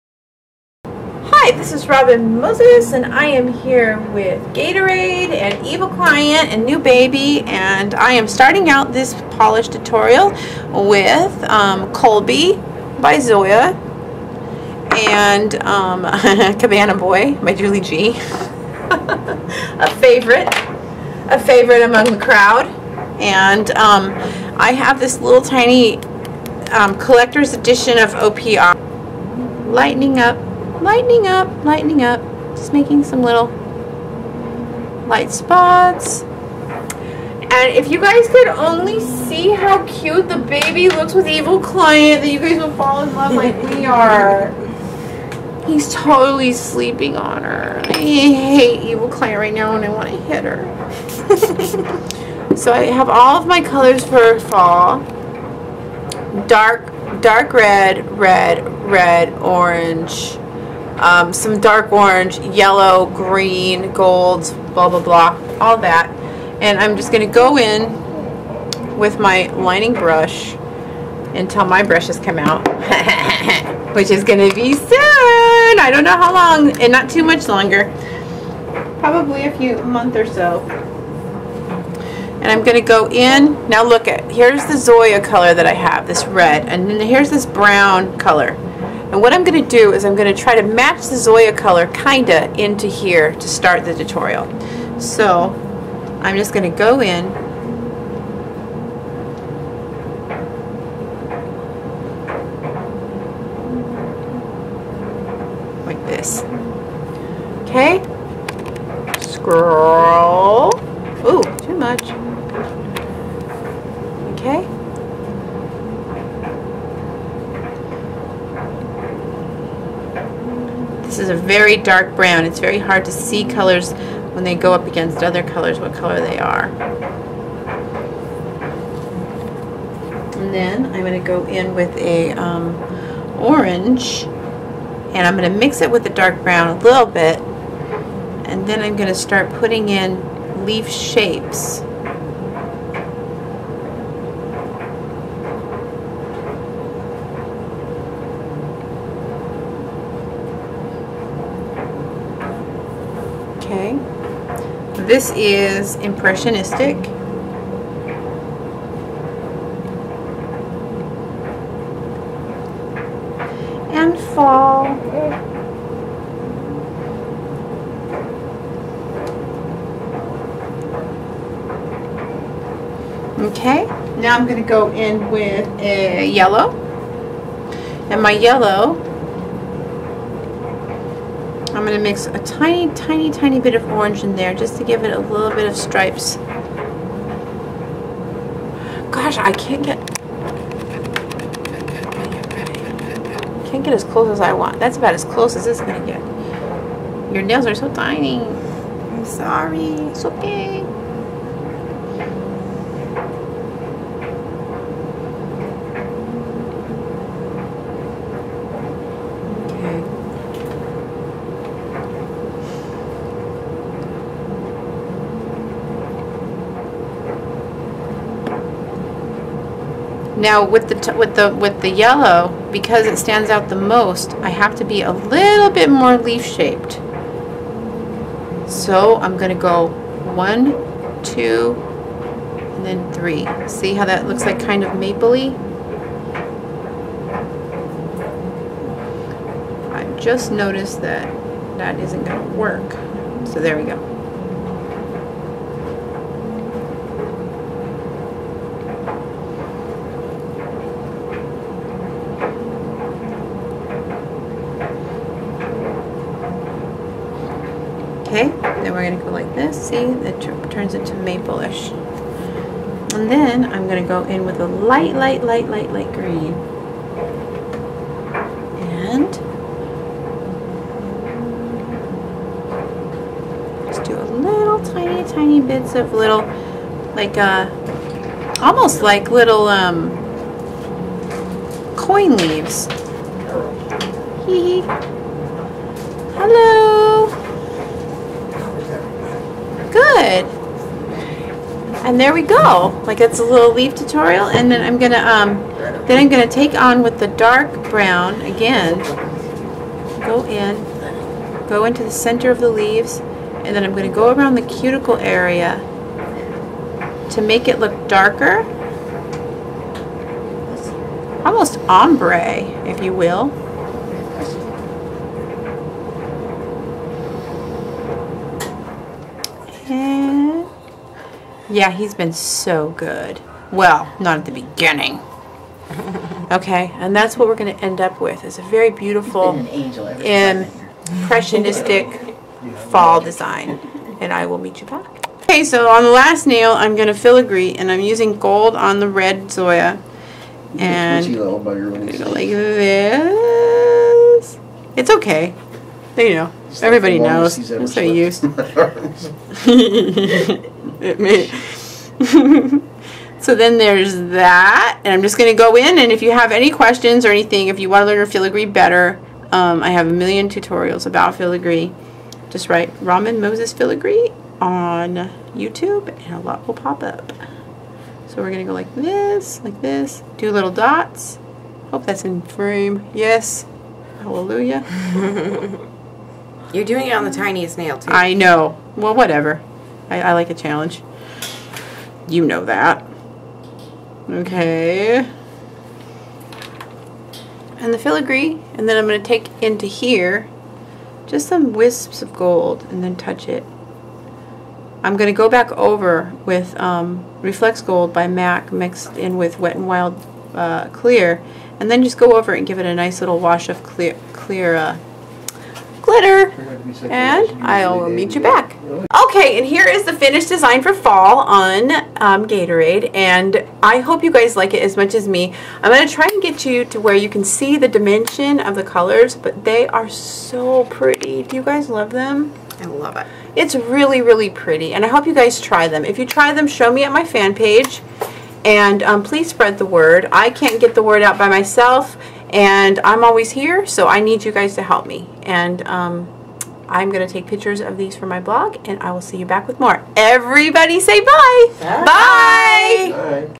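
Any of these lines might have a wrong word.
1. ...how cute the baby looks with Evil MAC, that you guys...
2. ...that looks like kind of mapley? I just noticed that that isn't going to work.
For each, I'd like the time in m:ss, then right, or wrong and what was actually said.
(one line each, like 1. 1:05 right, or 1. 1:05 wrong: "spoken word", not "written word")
1. 0:39 wrong: "Client", not "MAC"
2. 3:54 right.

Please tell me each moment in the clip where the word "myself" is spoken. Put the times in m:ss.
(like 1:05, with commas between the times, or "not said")
7:11.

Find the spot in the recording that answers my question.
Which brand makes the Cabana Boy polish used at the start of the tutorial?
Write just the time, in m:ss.
0:16.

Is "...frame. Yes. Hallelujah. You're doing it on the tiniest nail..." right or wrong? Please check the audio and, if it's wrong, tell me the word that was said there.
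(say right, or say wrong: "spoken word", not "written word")
right.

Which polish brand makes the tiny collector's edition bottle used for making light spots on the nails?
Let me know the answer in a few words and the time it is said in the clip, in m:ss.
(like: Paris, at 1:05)
OPI, at 0:28.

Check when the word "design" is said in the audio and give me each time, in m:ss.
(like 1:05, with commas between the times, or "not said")
5:33, 6:50.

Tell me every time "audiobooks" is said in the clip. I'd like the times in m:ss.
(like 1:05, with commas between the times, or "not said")
not said.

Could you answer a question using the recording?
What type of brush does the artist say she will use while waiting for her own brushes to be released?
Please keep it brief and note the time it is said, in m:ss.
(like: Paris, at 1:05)
lining brush, at 1:09.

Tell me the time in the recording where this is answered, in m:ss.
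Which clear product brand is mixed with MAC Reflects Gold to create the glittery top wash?
6:39.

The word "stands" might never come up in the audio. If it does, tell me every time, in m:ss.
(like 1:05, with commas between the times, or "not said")
3:43.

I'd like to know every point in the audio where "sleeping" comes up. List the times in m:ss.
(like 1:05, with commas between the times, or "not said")
0:46.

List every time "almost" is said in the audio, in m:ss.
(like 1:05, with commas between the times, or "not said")
4:38, 5:11.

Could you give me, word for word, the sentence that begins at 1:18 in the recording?
Probably a few month or so.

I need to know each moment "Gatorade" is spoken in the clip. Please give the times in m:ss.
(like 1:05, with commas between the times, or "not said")
0:04, 6:52.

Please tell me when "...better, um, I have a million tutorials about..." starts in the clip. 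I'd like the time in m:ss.
5:58.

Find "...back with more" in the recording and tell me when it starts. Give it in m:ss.
7:19.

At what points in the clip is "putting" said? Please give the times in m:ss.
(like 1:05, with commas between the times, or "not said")
2:19.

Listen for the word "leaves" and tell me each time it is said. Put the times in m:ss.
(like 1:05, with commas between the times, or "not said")
4:42, 5:02.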